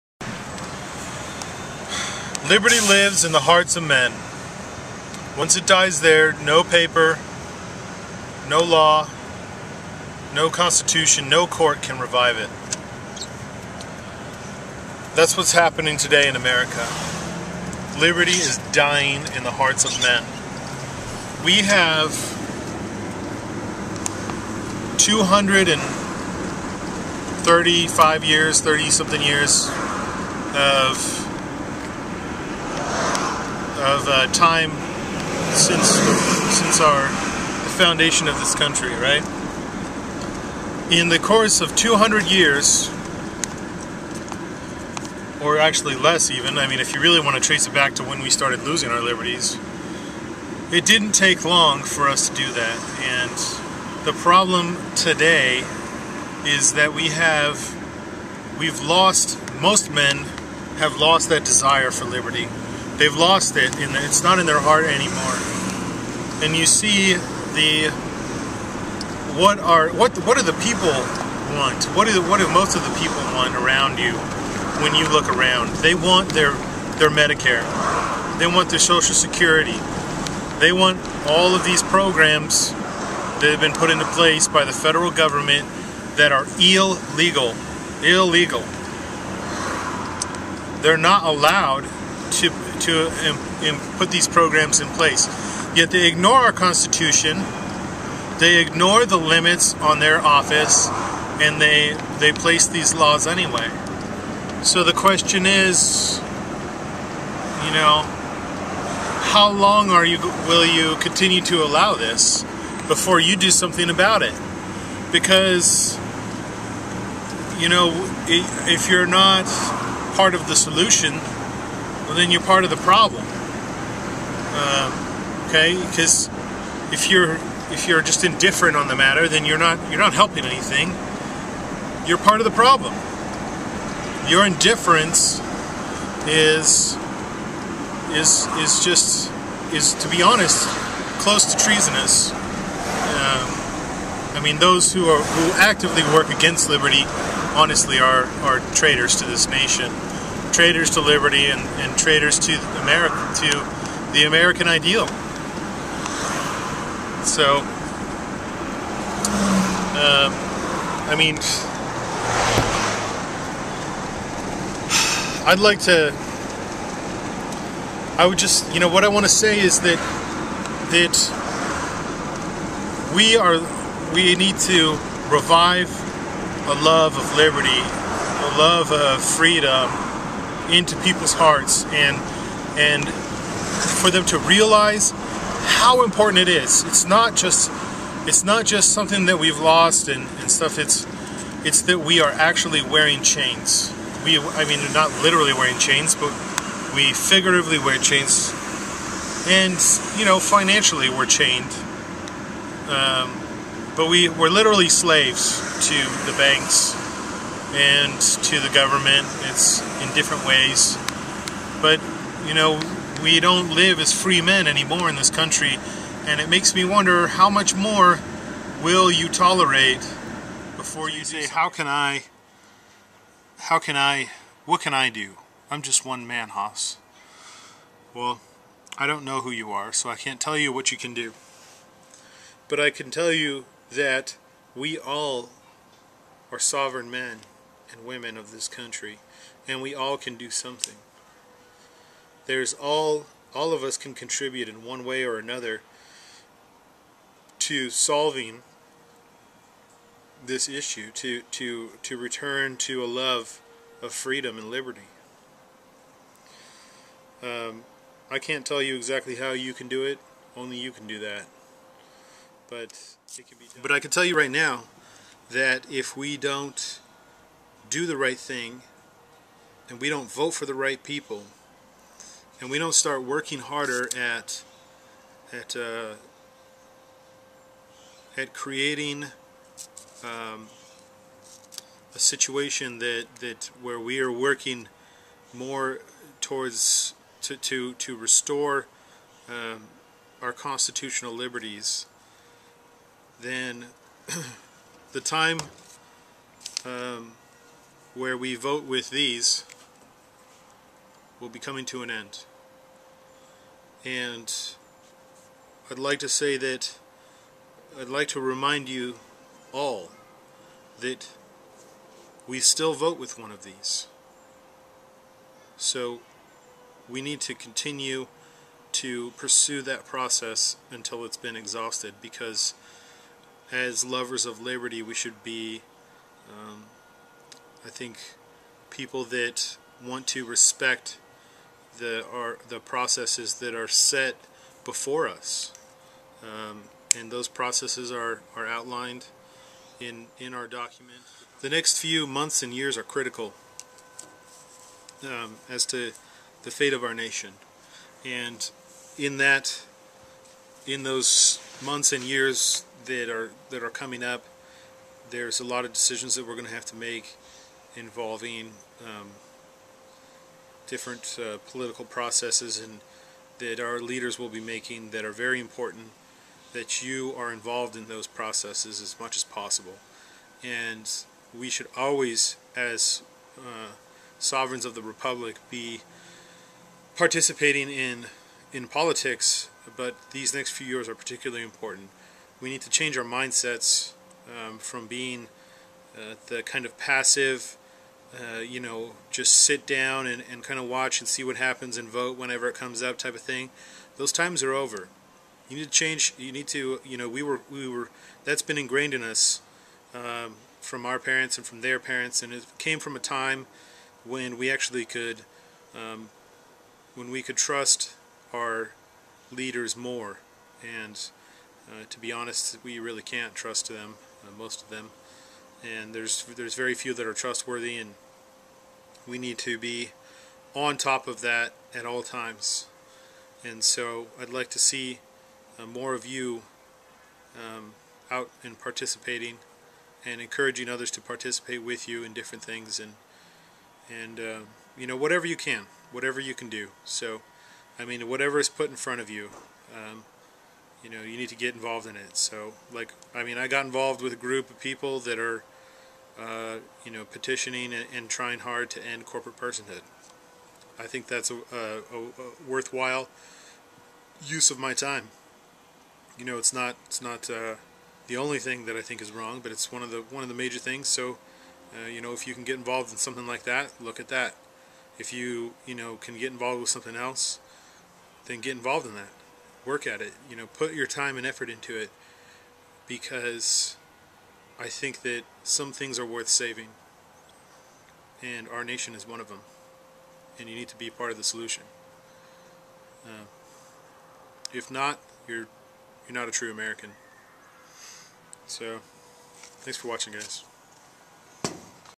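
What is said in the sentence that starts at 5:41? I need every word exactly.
The next few months and years are critical um, as to the fate of our nation.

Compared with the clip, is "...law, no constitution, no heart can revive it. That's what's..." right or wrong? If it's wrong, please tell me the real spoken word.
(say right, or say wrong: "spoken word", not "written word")
wrong: "court", not "heart".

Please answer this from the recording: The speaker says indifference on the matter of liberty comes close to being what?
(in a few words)
treasonous.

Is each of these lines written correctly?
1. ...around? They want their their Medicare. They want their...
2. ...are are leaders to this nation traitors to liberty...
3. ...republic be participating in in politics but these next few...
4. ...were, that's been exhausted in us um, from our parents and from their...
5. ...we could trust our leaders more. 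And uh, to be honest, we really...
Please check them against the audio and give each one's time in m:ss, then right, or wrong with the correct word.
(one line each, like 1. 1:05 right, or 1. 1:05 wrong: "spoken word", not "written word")
1. 1:15 right
2. 2:27 wrong: "traitors", not "leaders"
3. 6:15 right
4. 6:37 wrong: "ingrained", not "exhausted"
5. 6:47 right.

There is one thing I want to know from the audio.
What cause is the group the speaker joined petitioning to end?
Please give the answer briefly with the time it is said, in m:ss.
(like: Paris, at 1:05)
corporate personhood, at 7:29.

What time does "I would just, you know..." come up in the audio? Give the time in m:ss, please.
2:48.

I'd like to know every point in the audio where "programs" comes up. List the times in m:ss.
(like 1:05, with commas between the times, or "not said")
1:21, 1:34.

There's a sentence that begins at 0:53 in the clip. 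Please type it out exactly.
And the problem today is that we have, we've lost, most men have lost that desire for liberty.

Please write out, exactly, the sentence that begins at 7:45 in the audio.
If you you know can get involved with something else, then get involved in that.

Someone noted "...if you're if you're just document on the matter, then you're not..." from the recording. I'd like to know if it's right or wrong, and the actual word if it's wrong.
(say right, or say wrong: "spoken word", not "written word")
wrong: "indifferent", not "document".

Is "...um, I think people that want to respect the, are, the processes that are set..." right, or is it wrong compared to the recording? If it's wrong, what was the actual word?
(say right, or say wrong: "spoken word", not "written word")
right.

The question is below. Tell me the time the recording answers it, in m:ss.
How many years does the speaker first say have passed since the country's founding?
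0:24.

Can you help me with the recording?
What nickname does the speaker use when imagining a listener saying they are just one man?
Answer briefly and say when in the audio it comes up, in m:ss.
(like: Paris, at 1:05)
Hoss, at 3:46.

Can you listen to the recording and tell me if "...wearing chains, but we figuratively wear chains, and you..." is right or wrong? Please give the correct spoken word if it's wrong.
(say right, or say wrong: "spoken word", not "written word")
right.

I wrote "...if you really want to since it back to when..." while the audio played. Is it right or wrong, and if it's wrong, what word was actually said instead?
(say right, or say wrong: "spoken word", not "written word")
wrong: "trace", not "since".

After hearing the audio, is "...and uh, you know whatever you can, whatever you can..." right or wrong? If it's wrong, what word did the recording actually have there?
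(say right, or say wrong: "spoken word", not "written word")
right.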